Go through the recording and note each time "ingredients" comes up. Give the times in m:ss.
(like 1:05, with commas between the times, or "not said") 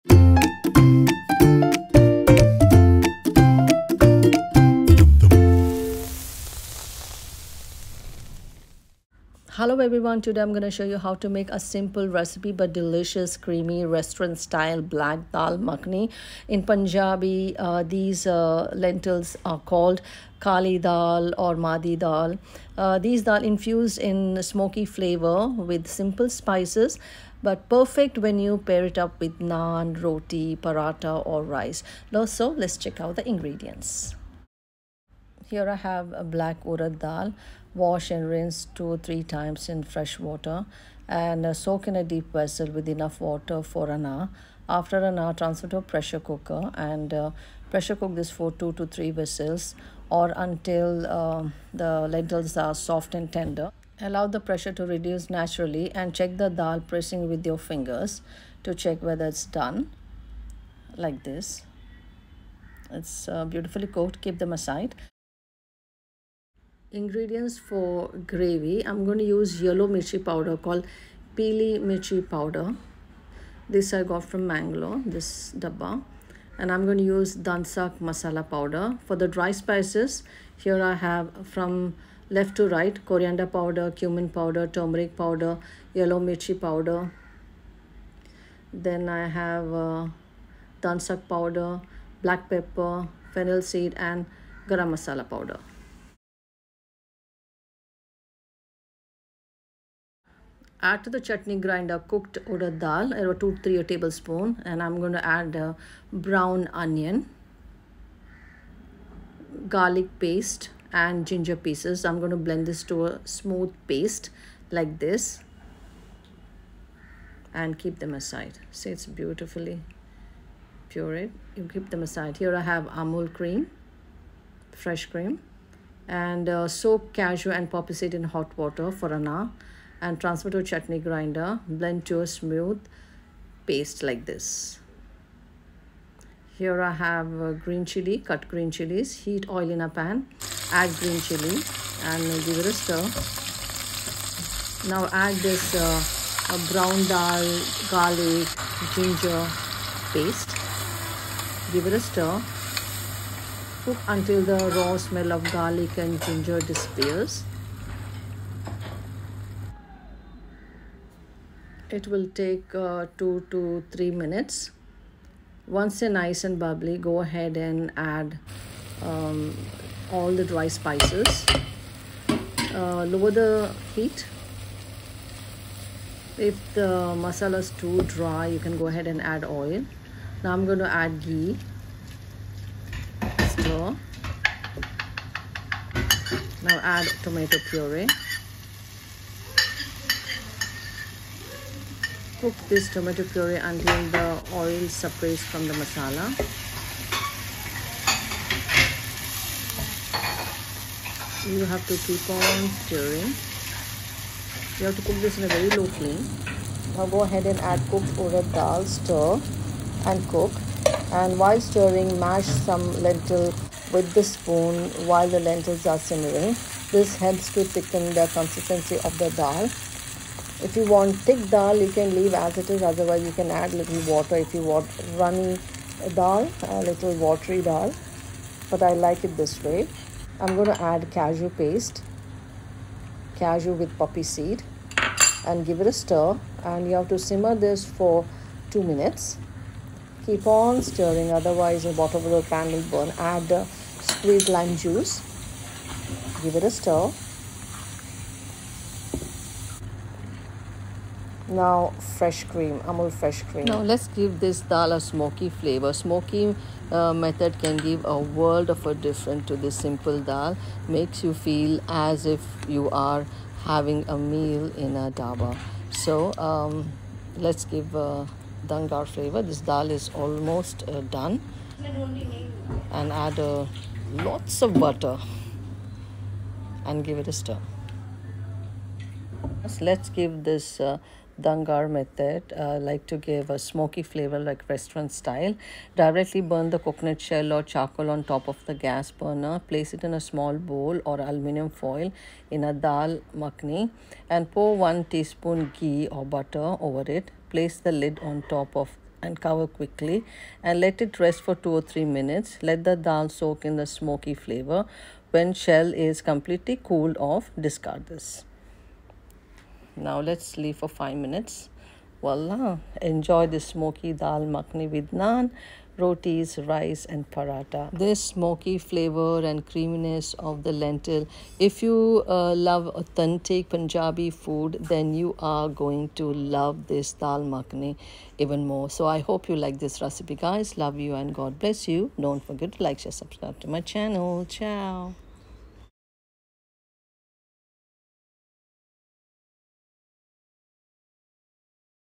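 0:33, 1:06.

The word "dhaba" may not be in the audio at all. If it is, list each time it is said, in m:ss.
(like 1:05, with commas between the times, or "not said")
4:25.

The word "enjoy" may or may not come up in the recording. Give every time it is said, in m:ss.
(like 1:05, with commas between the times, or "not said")
5:13.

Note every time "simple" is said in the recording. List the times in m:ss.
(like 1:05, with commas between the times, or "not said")
0:11, 0:25, 4:19.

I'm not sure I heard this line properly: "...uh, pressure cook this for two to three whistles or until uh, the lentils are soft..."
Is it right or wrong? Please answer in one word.
right.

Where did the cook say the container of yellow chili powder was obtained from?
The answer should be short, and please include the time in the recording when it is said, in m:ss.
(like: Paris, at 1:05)
Mangalore, at 1:14.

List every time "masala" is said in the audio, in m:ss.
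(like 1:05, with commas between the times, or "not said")
1:17, 1:34, 2:57, 3:15.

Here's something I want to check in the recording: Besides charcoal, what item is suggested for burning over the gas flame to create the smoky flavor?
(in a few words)
coconut shell.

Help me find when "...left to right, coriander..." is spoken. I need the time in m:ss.
1:22.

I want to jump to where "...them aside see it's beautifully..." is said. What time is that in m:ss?
1:58.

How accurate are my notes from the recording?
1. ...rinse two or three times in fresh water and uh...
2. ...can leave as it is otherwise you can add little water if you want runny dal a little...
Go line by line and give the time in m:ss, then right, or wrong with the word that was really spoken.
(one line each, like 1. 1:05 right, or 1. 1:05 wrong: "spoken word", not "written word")
1. 0:38 right
2. 3:41 right.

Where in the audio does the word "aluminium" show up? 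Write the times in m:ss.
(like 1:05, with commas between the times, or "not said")
4:51.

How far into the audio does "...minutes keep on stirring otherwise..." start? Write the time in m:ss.
3:58.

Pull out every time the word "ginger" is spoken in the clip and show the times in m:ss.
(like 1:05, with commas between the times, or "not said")
1:51, 2:28, 2:36.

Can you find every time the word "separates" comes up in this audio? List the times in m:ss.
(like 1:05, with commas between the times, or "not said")
3:14.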